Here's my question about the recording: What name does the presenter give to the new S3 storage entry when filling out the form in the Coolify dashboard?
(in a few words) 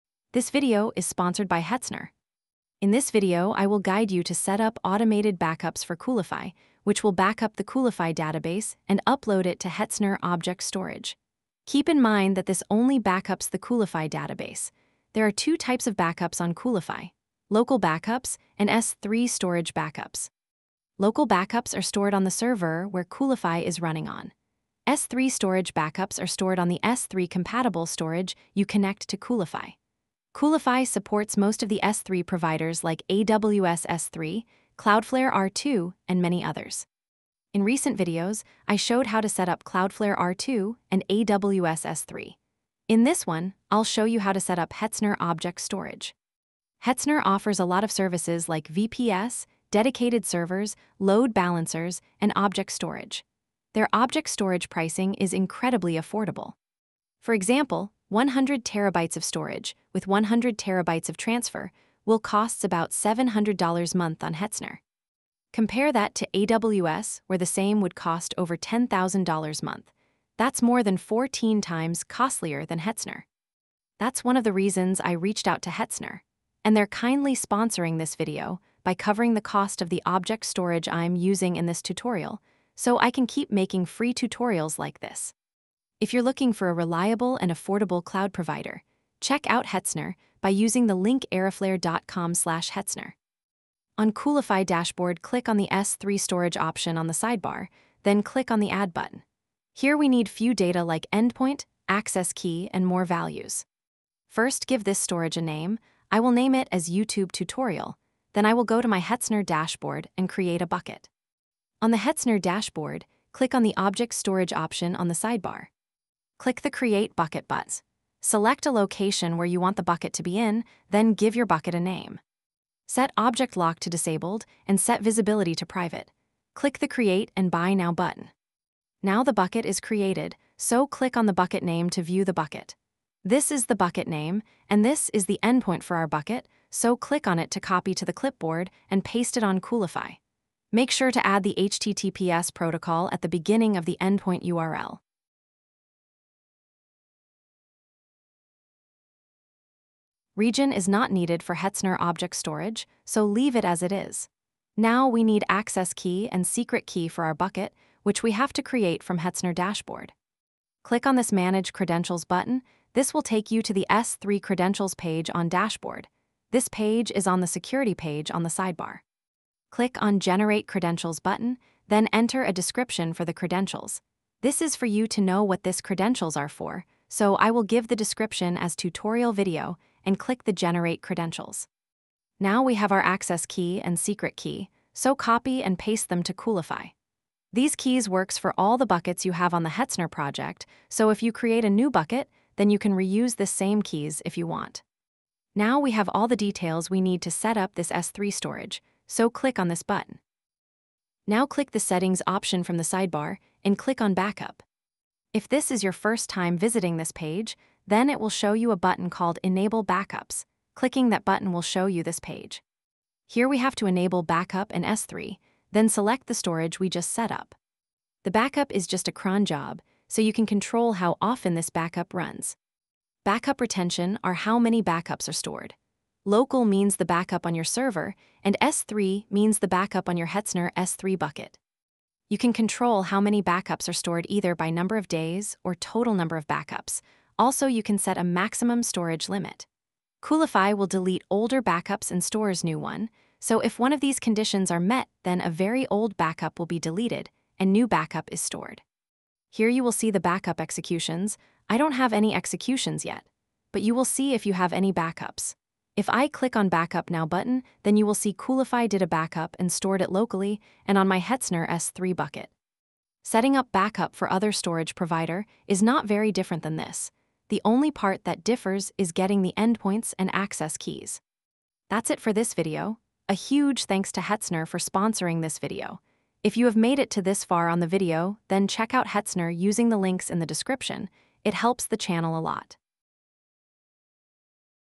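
YouTube tutorial.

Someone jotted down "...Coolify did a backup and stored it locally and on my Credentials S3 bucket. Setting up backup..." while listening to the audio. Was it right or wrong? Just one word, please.
wrong.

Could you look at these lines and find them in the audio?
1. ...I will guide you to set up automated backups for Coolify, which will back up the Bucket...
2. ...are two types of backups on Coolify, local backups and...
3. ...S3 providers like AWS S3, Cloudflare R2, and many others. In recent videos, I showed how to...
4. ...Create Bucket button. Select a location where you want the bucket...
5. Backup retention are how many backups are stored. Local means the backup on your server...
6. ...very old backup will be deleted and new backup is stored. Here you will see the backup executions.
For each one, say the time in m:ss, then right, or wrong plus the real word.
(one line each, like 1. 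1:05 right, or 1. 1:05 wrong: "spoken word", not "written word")
1. 0:03 wrong: "Coolify", not "Bucket"
2. 0:15 right
3. 0:31 right
4. 1:56 right
5. 3:43 right
6. 4:05 right.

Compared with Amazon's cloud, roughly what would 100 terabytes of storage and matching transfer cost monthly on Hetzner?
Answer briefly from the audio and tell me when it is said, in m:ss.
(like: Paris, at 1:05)
$700, at 1:02.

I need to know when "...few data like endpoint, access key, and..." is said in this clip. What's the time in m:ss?
1:40.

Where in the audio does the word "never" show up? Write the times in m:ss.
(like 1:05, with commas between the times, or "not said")
not said.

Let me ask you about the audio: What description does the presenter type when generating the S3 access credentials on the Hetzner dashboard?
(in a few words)
tutorial video.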